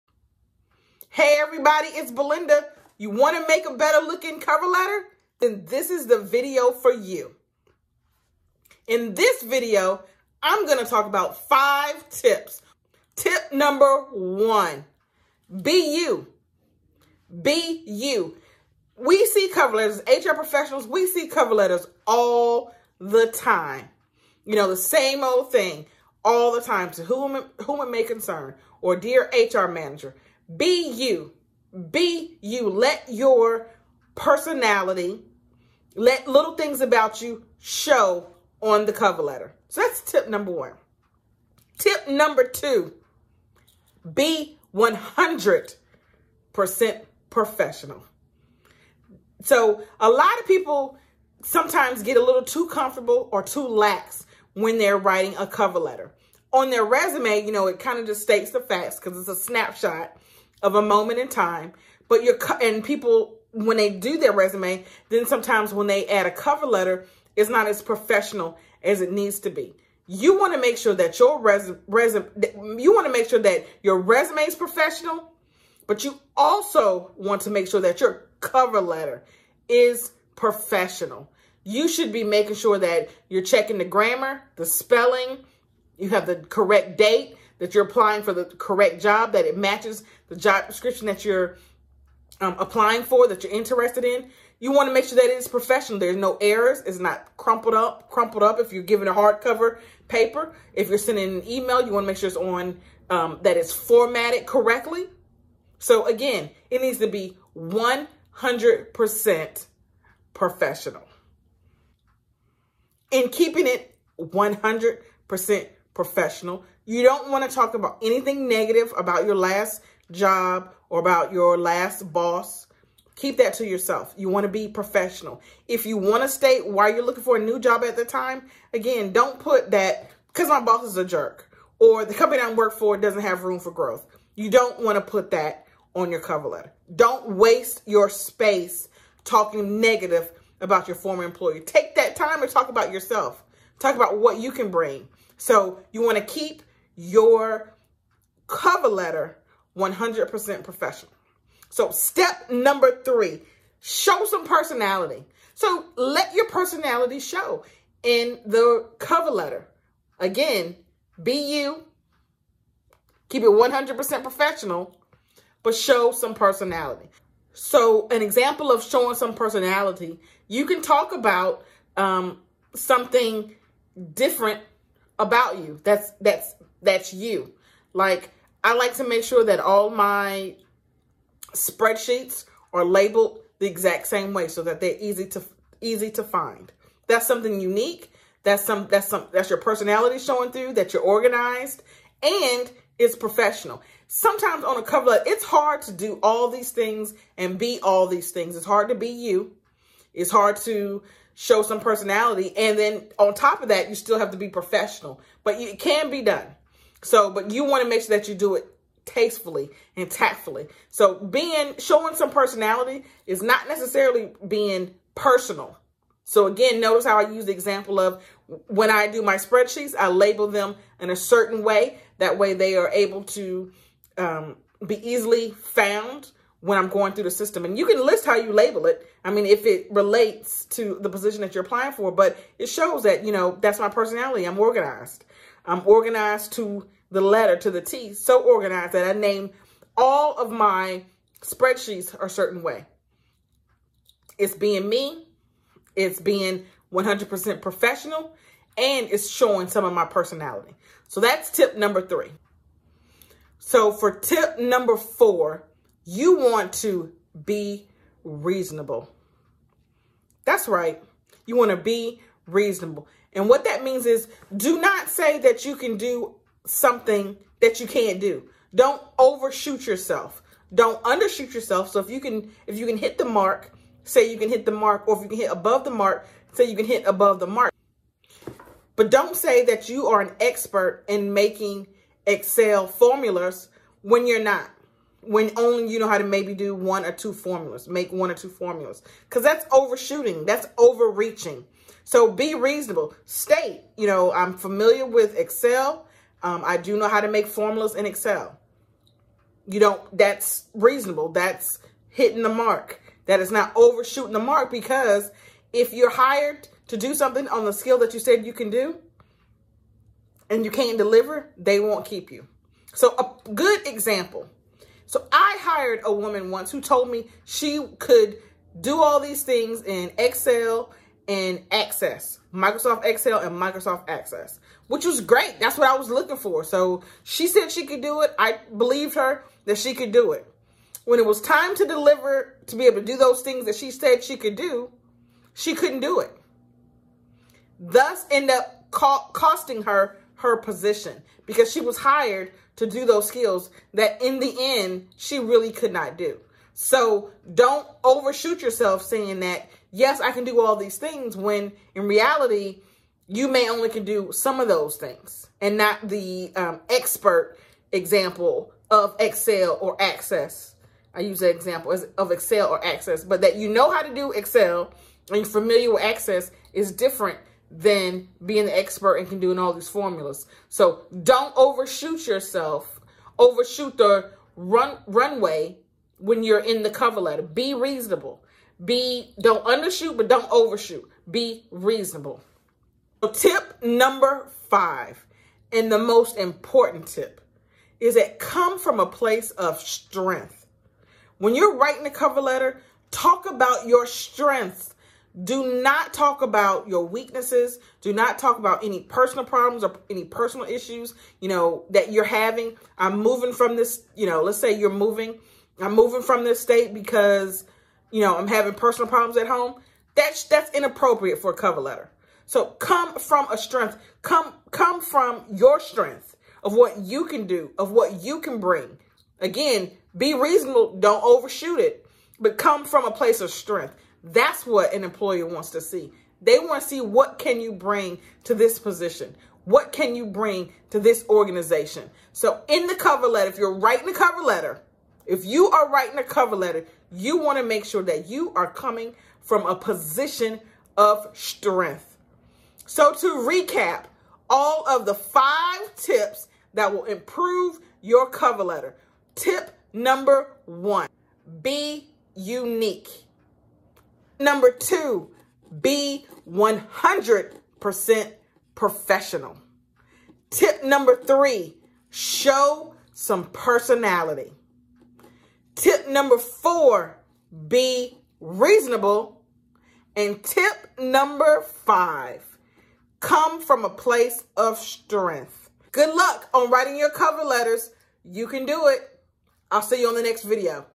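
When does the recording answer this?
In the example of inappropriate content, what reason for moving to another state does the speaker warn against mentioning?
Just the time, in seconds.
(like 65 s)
408 s.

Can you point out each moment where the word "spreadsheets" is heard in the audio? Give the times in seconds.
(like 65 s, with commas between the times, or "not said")
181 s, 219 s, 241 s.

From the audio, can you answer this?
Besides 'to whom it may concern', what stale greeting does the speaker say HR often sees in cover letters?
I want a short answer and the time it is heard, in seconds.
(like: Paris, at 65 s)
Dear HR manager, at 28 s.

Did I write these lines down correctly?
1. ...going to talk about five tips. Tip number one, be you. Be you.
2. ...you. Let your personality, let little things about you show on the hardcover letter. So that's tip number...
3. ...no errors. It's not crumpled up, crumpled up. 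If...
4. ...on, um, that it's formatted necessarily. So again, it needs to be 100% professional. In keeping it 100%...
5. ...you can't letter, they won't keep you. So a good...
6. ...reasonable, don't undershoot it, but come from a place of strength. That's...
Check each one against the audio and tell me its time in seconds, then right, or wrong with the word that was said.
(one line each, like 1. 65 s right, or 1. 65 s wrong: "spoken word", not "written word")
1. 10 s right
2. 32 s wrong: "cover", not "hardcover"
3. 96 s right
4. 102 s wrong: "correctly", not "necessarily"
5. 310 s wrong: "deliver", not "letter"
6. 420 s wrong: "overshoot", not "undershoot".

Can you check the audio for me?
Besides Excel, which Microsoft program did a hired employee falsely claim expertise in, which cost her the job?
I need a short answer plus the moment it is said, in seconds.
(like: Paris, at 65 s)
Microsoft Access, at 323 s.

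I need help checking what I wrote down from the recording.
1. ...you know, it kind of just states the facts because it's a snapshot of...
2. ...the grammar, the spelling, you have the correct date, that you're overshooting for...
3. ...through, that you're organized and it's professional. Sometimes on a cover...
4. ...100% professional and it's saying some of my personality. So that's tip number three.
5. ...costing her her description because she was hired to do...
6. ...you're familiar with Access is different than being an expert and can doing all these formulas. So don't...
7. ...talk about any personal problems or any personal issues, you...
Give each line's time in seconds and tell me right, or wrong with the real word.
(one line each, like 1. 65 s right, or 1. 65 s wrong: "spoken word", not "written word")
1. 57 s right
2. 83 s wrong: "applying", not "overshooting"
3. 190 s right
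4. 246 s wrong: "showing", not "saying"
5. 339 s wrong: "position", not "description"
6. 365 s right
7. 398 s right.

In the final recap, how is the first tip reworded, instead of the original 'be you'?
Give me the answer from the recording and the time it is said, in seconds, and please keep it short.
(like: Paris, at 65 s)
Be unique, at 451 s.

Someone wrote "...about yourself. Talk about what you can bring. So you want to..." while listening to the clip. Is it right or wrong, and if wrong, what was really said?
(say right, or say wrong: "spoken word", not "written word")
right.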